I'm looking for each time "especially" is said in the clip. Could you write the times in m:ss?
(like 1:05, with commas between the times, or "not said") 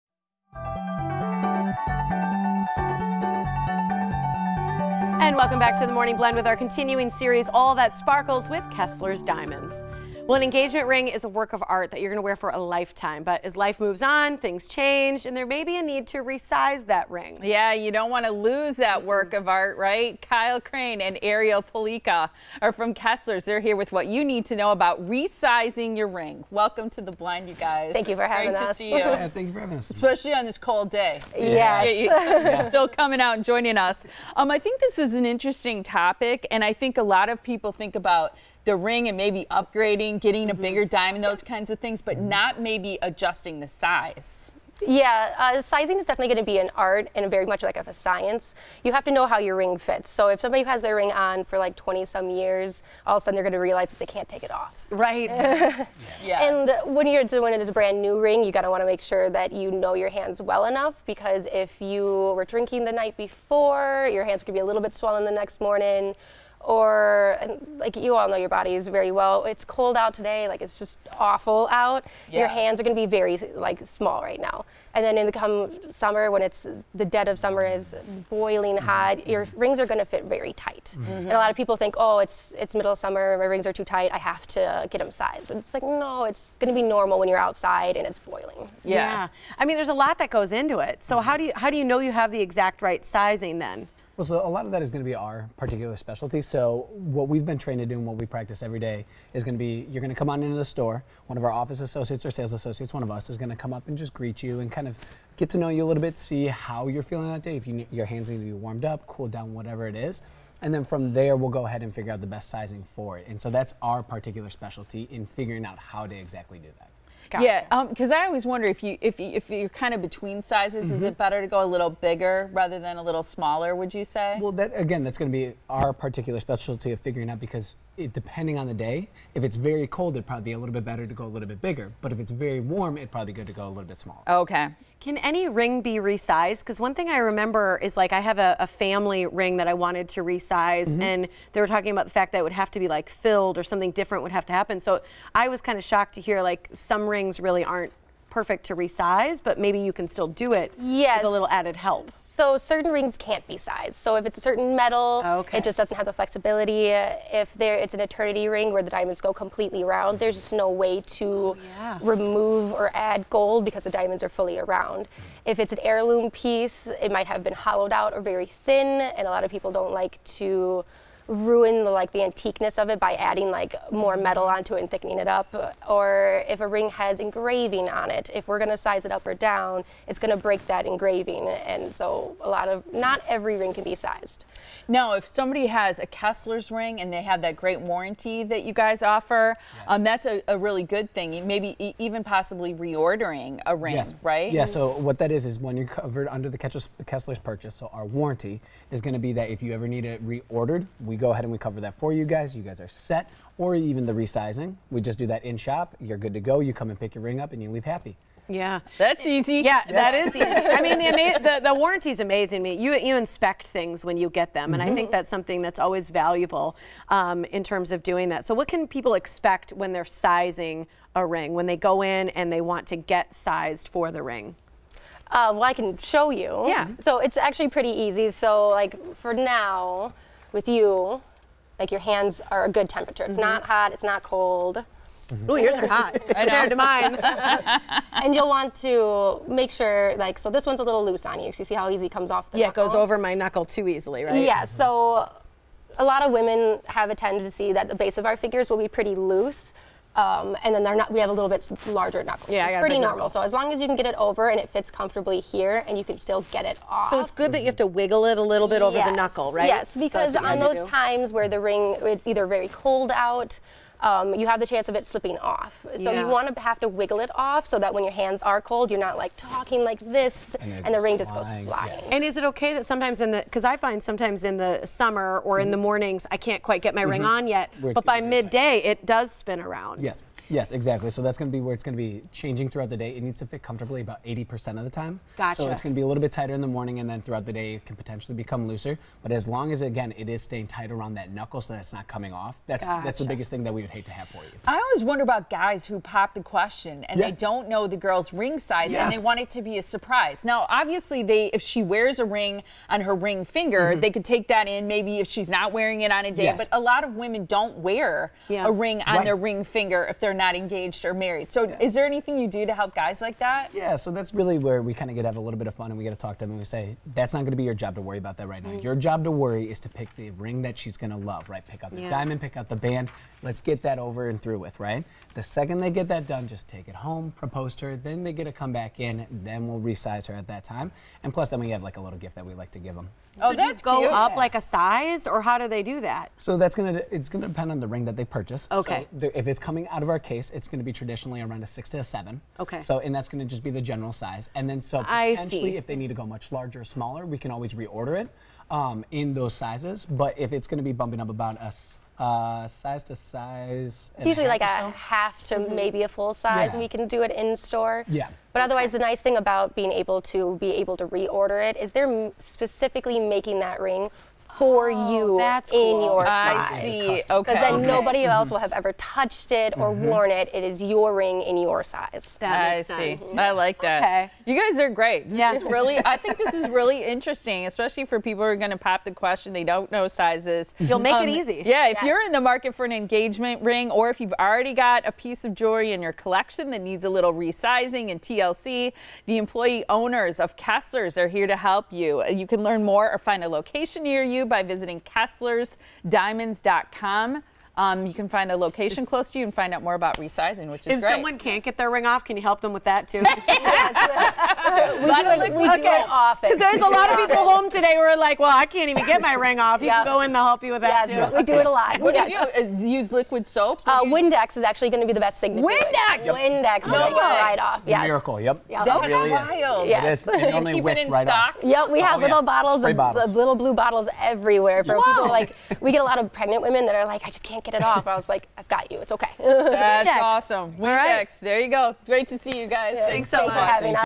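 0:29, 6:17.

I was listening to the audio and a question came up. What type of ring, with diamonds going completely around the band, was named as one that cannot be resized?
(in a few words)
Eternity ring.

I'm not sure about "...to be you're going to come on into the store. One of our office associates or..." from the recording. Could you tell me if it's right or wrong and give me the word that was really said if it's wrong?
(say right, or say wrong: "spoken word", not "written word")
right.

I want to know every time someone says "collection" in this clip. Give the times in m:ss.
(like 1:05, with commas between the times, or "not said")
6:26.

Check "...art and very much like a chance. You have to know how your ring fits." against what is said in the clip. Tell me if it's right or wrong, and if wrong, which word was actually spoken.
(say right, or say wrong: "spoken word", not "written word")
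wrong: "science", not "chance".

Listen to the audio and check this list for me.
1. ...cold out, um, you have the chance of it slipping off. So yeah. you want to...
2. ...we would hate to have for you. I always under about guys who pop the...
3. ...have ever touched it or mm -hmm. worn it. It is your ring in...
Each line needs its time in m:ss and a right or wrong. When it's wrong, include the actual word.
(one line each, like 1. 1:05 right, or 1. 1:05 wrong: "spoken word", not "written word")
1. 4:22 right
2. 4:53 wrong: "wonder", not "under"
3. 6:08 right.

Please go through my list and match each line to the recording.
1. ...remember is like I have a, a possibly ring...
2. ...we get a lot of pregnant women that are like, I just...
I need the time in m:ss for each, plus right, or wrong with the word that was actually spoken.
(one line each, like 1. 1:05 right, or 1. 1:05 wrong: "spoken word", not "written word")
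1. 2:17 wrong: "family", not "possibly"
2. 7:05 right.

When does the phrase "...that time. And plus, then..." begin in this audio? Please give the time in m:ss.
5:30.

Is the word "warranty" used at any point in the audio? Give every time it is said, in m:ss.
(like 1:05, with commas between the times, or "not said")
3:07, 3:18, 3:31.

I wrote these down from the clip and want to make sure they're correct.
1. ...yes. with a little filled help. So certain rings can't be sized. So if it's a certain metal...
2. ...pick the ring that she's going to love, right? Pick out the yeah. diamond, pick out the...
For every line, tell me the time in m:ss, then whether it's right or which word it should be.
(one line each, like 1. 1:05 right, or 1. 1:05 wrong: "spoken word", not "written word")
1. 2:30 wrong: "added", not "filled"
2. 5:19 right.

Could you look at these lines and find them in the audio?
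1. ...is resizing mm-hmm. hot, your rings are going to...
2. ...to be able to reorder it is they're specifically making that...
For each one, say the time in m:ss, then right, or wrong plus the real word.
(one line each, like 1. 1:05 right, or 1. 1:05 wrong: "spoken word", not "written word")
1. 1:17 wrong: "boiling", not "resizing"
2. 6:00 right.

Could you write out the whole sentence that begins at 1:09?
It's cold out today, like it's just awful out.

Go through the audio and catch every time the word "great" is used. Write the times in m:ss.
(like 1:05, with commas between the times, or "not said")
0:28, 3:07, 6:14, 6:40, 7:12.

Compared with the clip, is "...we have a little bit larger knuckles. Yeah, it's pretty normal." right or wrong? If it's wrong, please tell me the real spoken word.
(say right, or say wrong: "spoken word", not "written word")
right.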